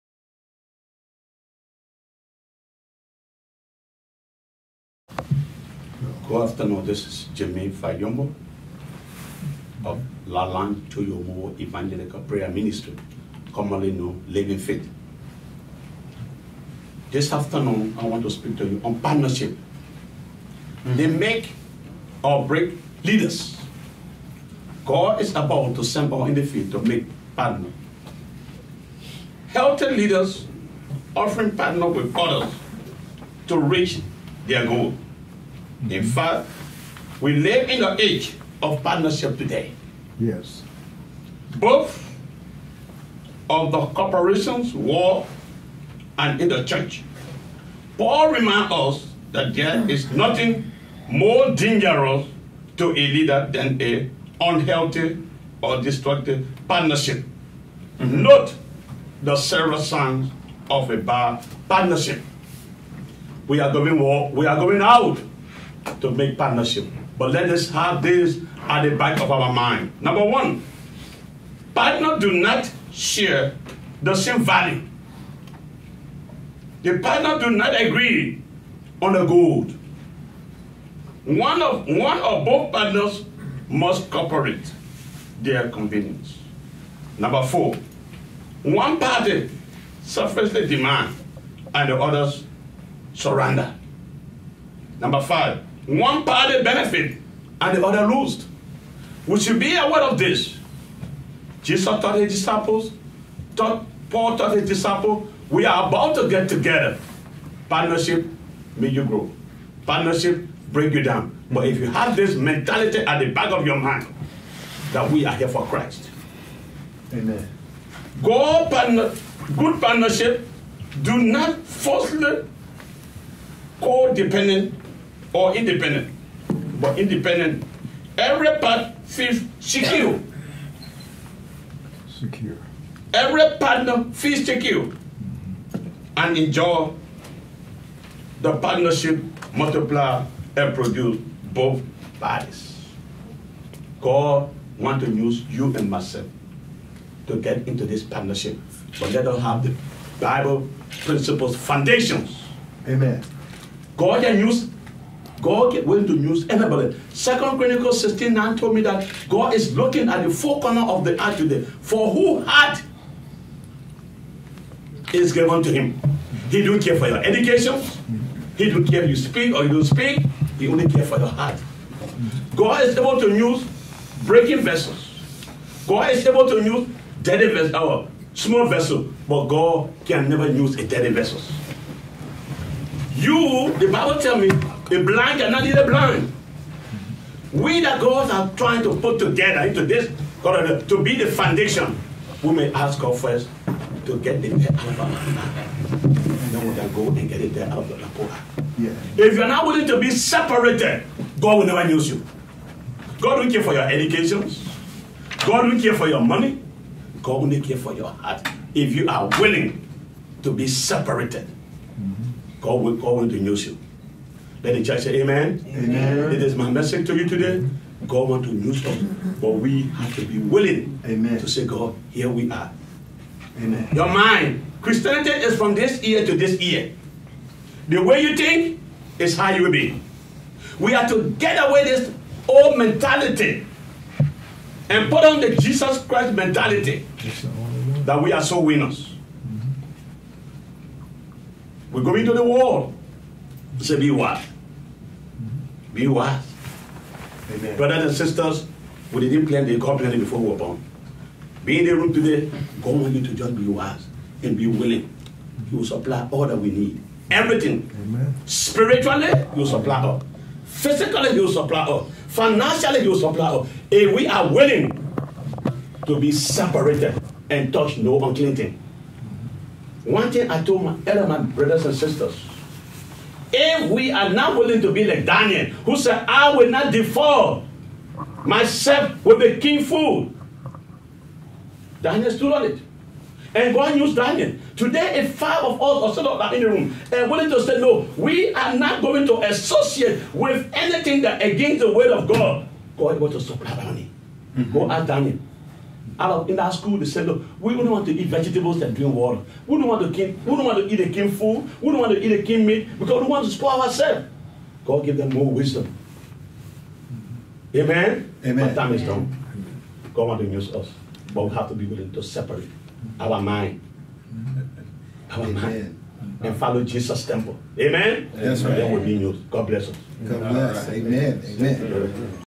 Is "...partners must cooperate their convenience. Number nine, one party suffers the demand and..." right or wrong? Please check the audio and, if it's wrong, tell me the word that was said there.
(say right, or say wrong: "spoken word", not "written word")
wrong: "four", not "nine".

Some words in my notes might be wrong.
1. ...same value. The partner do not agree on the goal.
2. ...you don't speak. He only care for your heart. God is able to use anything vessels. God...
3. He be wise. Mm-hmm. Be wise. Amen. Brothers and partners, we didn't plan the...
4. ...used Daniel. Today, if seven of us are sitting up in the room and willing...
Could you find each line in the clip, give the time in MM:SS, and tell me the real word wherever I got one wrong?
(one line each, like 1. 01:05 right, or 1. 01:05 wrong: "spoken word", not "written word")
1. 01:14 right
2. 02:49 wrong: "breaking", not "anything"
3. 04:03 wrong: "sisters", not "partners"
4. 04:43 wrong: "five", not "seven".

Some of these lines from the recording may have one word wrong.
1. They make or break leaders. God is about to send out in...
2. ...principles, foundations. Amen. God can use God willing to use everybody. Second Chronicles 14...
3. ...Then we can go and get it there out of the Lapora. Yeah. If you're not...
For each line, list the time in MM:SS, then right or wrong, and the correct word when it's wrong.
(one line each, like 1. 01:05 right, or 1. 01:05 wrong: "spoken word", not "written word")
1. 00:20 right
2. 02:31 wrong: "16", not "14"
3. 03:15 right.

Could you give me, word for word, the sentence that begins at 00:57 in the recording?
Note the several signs of a bad partnership.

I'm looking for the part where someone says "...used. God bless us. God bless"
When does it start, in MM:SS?
05:19.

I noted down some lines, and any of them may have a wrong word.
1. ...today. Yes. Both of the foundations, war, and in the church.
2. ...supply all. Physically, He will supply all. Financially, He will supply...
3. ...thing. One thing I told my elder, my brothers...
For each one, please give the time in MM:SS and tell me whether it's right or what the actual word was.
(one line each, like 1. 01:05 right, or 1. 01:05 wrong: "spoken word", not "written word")
1. 00:39 wrong: "corporations", not "foundations"
2. 04:19 right
3. 04:28 right.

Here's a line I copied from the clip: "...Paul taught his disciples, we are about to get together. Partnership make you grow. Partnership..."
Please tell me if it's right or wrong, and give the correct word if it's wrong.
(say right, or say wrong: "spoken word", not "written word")
right.